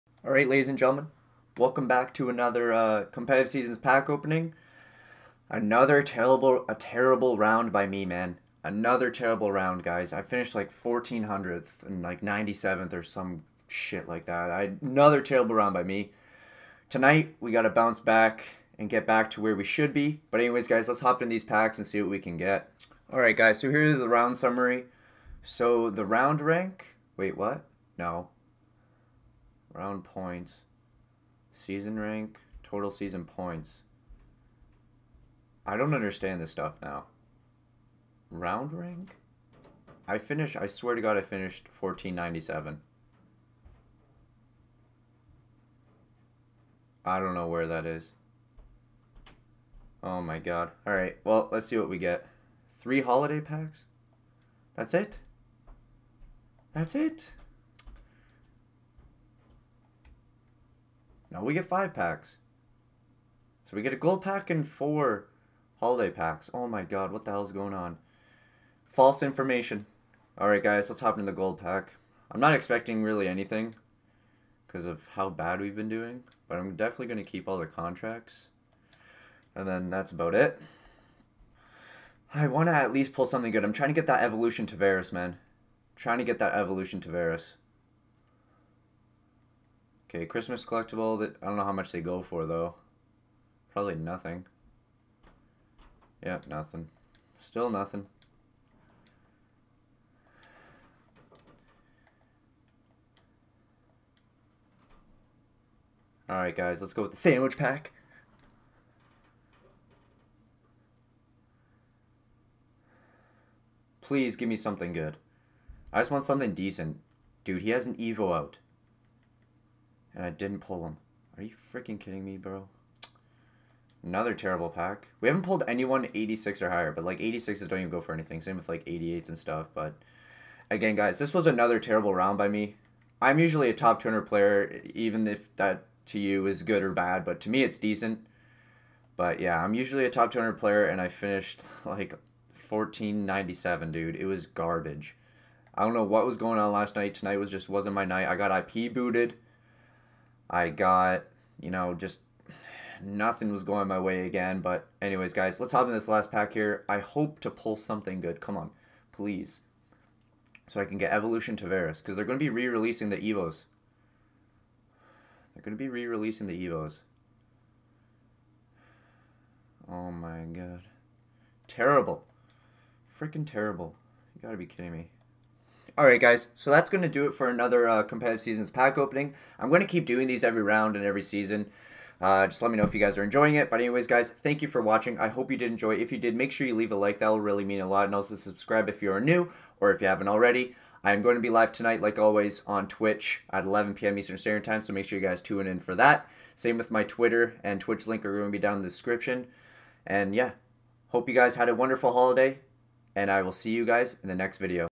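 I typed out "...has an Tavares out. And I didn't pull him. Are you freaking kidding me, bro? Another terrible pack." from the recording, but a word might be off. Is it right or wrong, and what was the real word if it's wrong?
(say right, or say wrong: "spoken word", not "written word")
wrong: "Evo", not "Tavares".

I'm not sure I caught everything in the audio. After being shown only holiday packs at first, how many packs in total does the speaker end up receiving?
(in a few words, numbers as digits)
5.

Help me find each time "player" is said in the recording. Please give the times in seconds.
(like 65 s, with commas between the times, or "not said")
134 s, 140 s.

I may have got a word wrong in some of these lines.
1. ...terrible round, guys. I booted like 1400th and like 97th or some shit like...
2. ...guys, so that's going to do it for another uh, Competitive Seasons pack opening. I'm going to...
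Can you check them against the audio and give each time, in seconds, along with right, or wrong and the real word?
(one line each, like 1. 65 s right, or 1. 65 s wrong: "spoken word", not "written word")
1. 9 s wrong: "finished", not "booted"
2. 176 s right.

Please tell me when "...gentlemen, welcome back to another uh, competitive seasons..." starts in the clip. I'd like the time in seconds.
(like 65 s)
0 s.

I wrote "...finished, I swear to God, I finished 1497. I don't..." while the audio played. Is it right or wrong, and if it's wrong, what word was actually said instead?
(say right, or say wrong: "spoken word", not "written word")
right.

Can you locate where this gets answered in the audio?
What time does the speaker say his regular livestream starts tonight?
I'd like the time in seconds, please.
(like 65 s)
193 s.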